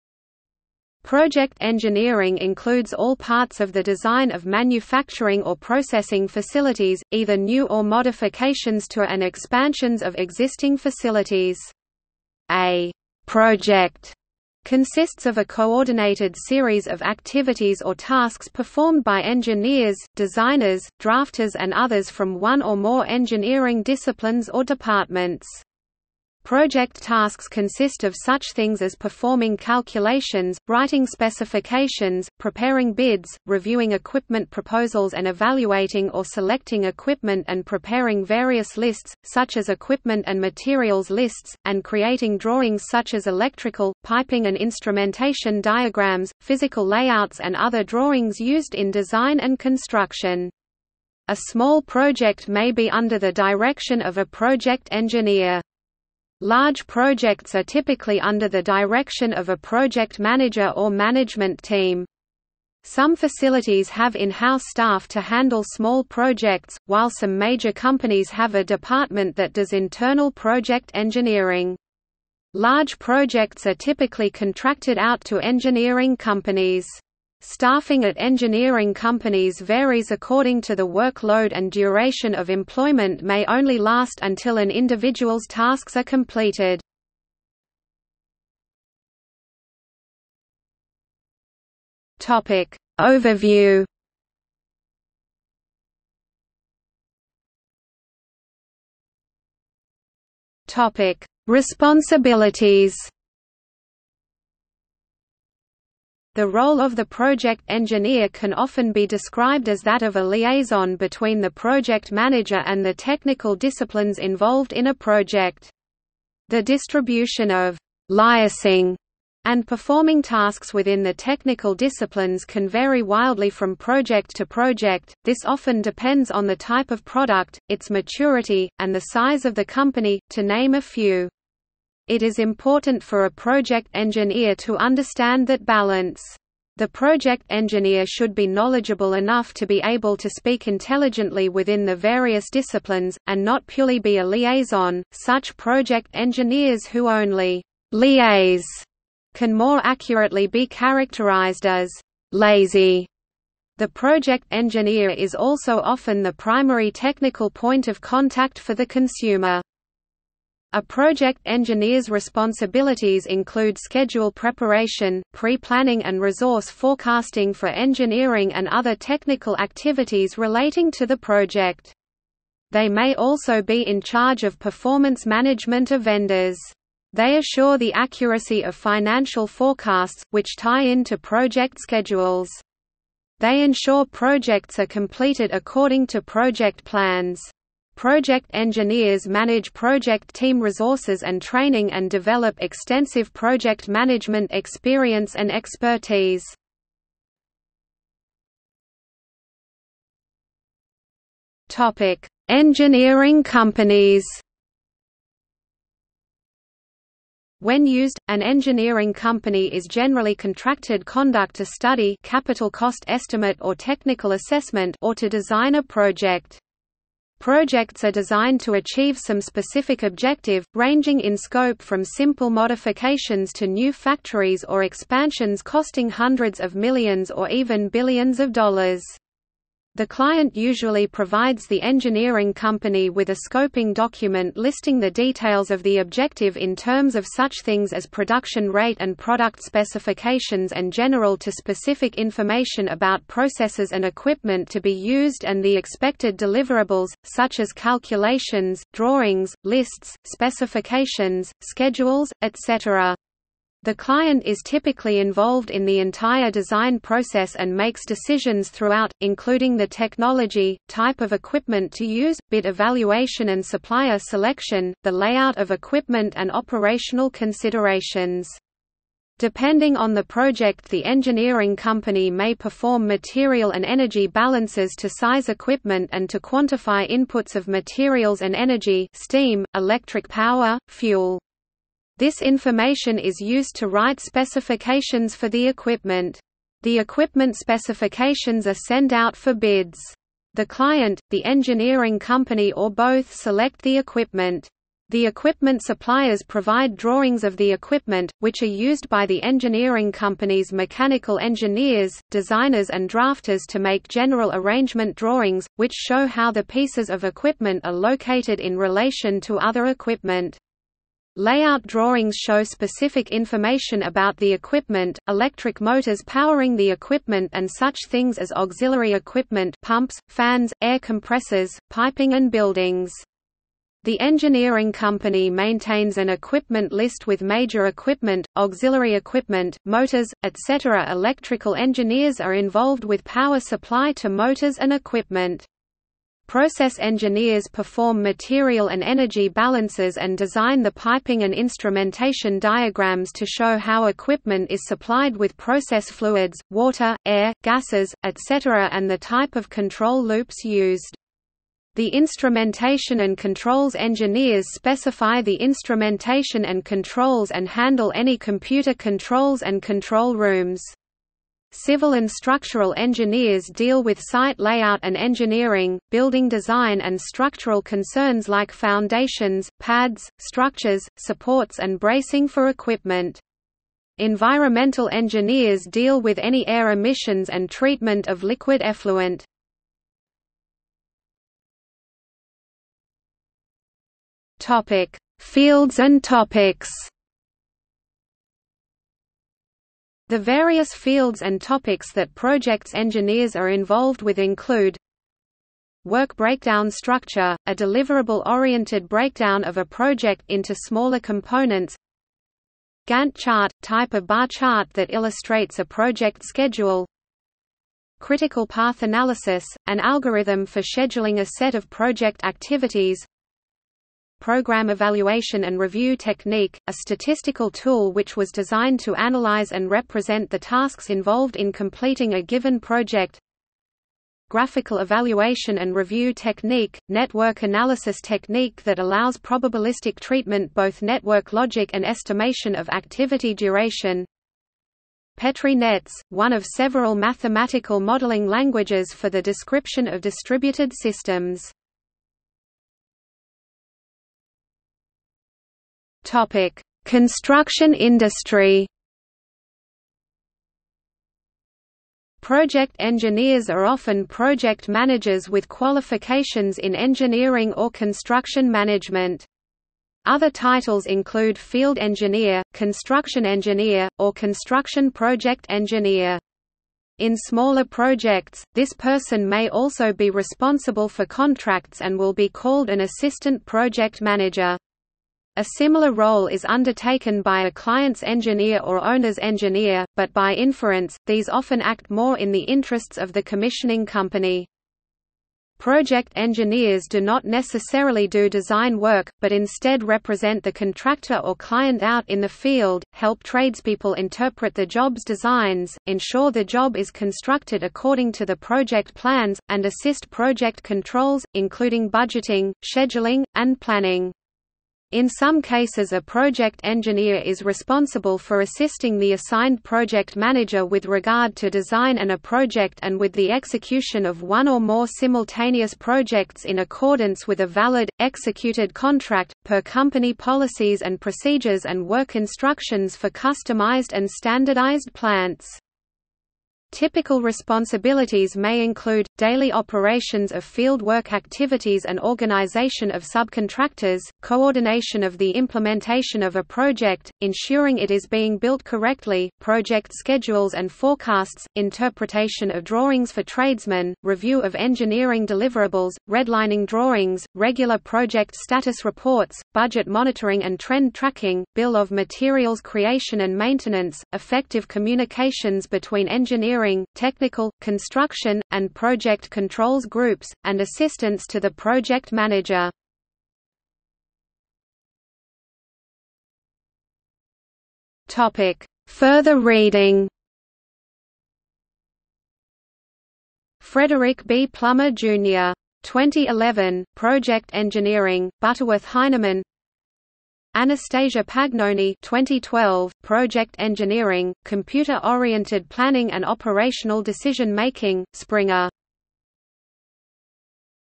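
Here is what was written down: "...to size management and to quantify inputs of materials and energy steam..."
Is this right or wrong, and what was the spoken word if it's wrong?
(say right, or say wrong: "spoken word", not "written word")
wrong: "equipment", not "management".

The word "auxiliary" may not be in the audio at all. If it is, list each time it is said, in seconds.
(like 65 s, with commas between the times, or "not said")
318 s, 328 s.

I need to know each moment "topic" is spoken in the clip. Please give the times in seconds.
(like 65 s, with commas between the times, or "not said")
92 s, 100 s, 201 s, 386 s, 391 s, 446 s.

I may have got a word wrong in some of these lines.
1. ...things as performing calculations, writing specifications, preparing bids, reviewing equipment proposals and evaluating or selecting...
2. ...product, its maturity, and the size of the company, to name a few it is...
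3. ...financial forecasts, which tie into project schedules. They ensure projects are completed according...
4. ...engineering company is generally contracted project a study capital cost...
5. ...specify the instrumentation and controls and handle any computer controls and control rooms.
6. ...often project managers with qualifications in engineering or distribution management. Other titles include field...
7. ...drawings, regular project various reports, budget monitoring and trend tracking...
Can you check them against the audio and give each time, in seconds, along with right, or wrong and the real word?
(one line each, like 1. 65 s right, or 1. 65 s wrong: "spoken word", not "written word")
1. 28 s right
2. 127 s right
3. 178 s right
4. 208 s wrong: "conduct", not "project"
5. 354 s right
6. 453 s wrong: "construction", not "distribution"
7. 546 s wrong: "status", not "various".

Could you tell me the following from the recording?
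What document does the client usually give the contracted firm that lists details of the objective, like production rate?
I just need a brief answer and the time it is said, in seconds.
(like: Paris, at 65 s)
Scoping document, at 233 s.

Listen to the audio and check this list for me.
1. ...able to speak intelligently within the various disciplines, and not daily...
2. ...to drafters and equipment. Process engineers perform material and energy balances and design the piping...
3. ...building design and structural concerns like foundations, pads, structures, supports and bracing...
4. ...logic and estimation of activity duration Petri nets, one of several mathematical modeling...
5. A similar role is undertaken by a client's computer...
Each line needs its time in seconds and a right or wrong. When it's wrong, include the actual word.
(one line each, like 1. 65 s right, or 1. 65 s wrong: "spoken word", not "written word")
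1. 139 s wrong: "purely", not "daily"
2. 334 s wrong: "motors", not "drafters"
3. 366 s right
4. 431 s right
5. 475 s wrong: "engineer", not "computer".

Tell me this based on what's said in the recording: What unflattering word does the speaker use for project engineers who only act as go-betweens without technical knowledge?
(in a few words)
Lazy.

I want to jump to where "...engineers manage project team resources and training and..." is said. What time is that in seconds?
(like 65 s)
188 s.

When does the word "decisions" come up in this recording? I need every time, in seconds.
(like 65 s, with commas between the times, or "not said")
258 s, 587 s.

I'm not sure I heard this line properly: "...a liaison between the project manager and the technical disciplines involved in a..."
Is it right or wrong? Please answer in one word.
right.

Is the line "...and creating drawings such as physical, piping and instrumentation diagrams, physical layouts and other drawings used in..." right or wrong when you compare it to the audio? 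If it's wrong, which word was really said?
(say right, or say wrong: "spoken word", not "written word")
wrong: "electrical", not "physical".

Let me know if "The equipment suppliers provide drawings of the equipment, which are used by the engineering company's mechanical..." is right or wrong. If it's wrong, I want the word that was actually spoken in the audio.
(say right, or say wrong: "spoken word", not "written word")
right.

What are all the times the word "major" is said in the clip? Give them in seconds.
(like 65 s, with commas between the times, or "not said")
67 s, 327 s.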